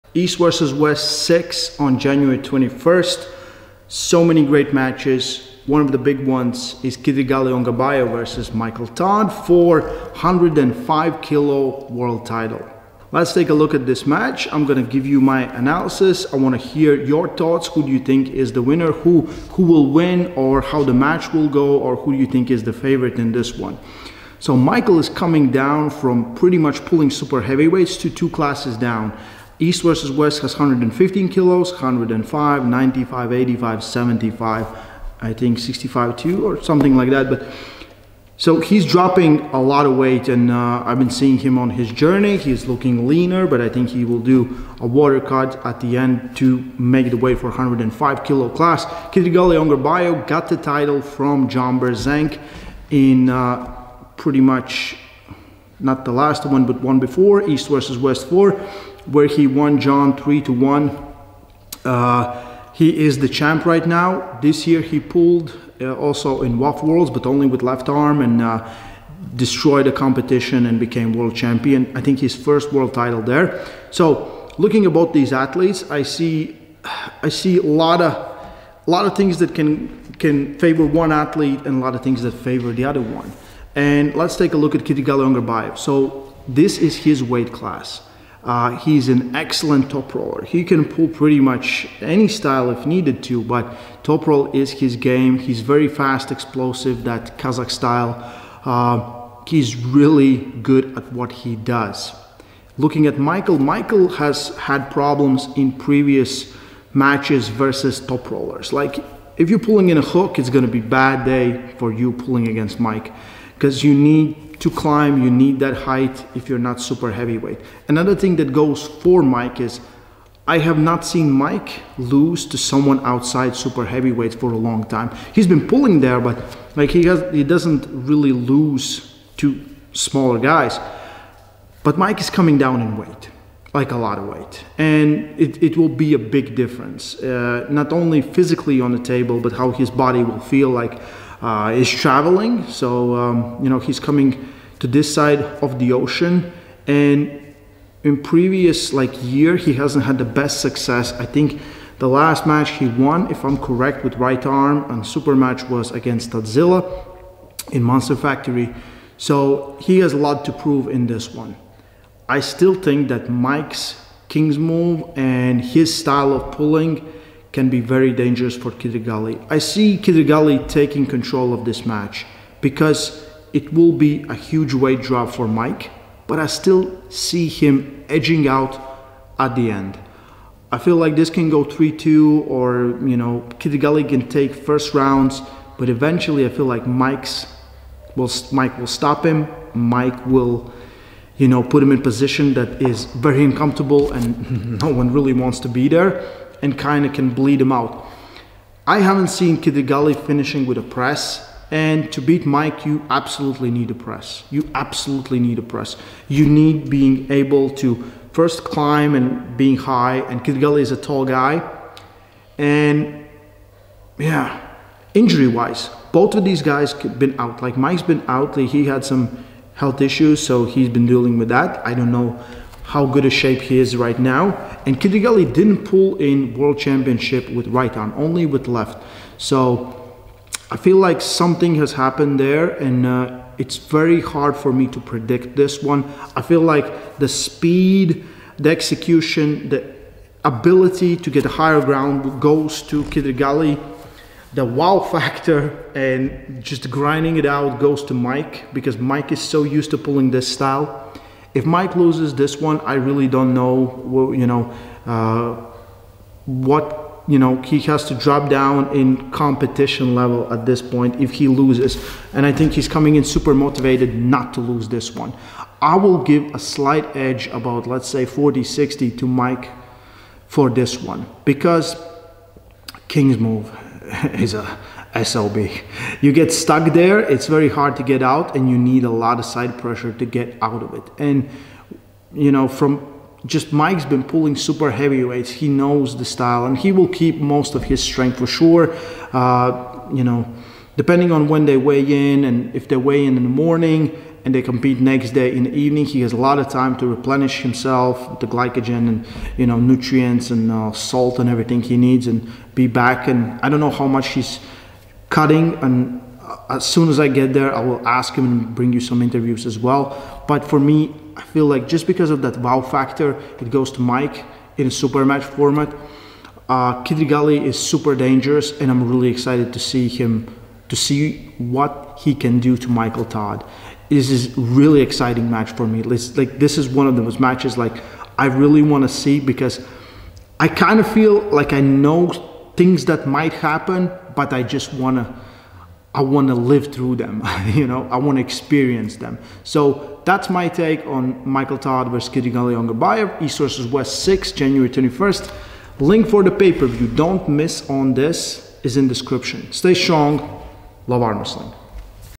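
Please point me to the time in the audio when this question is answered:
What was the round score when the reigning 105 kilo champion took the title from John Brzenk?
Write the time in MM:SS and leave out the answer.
01:00.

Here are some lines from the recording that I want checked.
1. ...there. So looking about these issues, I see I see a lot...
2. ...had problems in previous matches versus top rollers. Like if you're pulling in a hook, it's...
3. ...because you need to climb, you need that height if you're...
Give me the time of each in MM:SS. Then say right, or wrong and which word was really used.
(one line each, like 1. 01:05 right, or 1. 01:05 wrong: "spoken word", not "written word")
1. 01:13 wrong: "athletes", not "issues"
2. 01:44 right
3. 01:53 right.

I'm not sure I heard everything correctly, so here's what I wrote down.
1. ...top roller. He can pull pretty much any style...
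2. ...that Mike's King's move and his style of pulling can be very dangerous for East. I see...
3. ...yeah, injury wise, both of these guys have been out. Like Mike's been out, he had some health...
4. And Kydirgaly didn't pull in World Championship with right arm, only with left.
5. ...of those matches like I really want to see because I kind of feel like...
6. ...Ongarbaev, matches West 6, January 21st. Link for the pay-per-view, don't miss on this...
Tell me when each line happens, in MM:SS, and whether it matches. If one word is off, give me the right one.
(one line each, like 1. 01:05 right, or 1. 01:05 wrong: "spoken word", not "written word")
1. 01:29 right
2. 02:43 wrong: "Kydirgaly", not "East"
3. 03:34 right
4. 03:44 right
5. 05:27 right
6. 05:42 wrong: "eSources", not "matches".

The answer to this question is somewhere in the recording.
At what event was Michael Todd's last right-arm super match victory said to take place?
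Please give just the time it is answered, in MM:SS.
02:37.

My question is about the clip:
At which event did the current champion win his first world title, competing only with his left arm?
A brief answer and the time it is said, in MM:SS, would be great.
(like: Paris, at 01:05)
WAF Worlds, at 01:06.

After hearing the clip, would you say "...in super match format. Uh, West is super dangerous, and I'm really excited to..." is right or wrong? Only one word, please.
wrong.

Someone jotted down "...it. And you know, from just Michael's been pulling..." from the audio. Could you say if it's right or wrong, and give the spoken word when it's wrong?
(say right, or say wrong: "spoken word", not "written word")
wrong: "Mike", not "Michael".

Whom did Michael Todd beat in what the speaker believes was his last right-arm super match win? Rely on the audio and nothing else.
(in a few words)
Godzilla.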